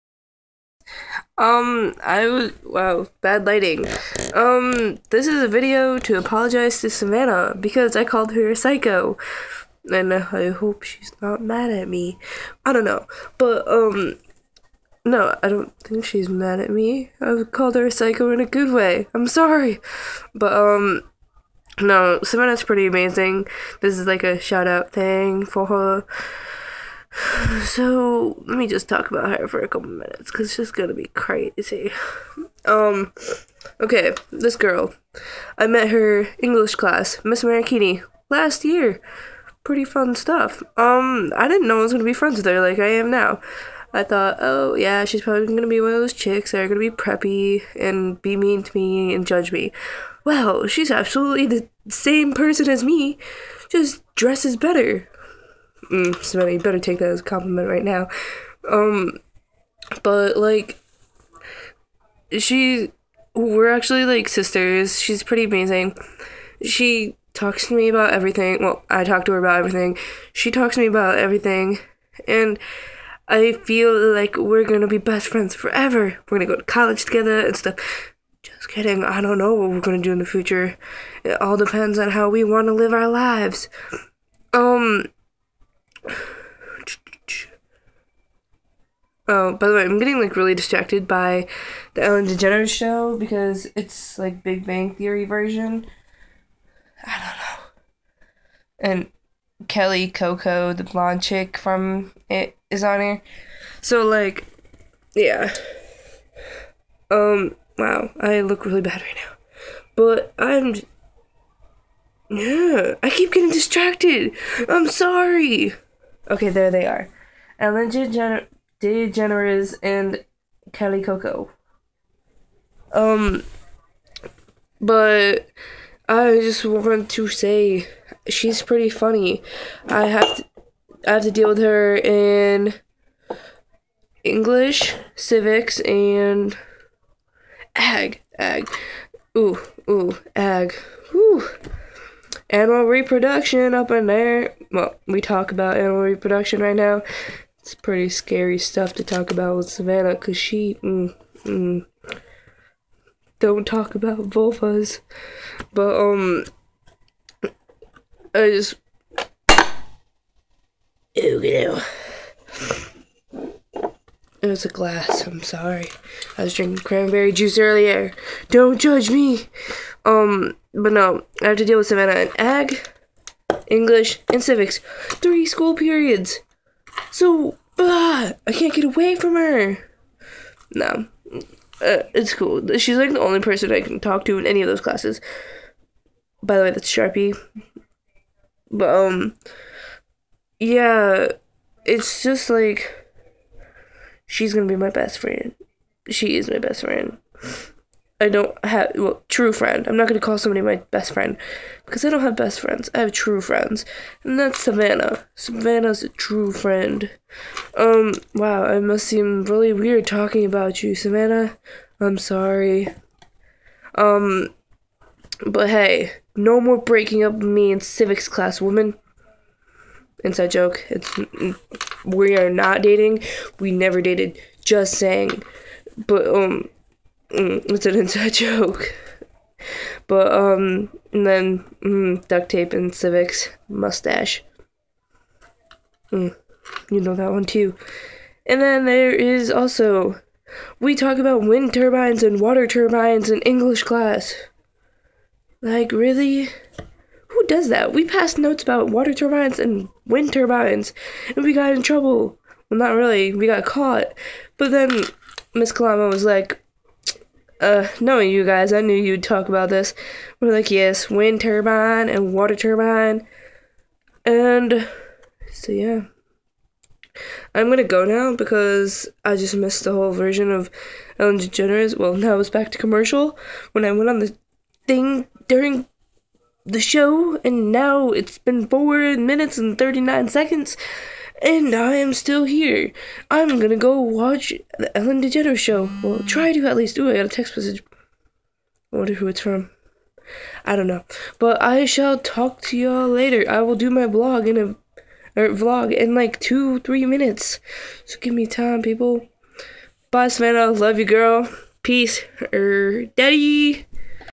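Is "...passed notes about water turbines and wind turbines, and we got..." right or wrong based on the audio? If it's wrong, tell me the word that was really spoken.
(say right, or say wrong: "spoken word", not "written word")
right.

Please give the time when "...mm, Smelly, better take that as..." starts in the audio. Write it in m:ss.
0:55.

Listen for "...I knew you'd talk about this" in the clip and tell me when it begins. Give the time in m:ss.
4:18.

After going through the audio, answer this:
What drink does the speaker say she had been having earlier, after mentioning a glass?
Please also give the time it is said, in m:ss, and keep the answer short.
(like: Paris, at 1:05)
cranberry juice, at 2:46.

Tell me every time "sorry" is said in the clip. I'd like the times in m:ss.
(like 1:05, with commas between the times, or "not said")
0:19, 1:54, 2:45, 3:32.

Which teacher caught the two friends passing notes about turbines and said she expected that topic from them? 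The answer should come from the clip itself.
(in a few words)
Miss Kalama.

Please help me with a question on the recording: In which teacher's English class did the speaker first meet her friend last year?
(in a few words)
Miss Marikini.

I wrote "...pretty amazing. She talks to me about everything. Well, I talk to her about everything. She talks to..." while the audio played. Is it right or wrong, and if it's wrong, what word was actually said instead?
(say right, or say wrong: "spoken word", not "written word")
right.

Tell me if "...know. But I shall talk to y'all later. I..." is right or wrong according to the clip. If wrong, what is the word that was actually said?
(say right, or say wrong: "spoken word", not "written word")
right.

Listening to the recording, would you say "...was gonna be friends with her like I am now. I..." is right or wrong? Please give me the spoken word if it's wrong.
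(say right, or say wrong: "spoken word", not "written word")
right.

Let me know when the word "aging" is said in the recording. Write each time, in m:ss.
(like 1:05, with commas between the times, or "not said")
not said.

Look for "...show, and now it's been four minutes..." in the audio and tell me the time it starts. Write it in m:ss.
4:36.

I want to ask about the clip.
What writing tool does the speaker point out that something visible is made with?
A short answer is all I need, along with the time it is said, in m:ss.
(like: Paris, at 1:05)
Sharpie, at 3:06.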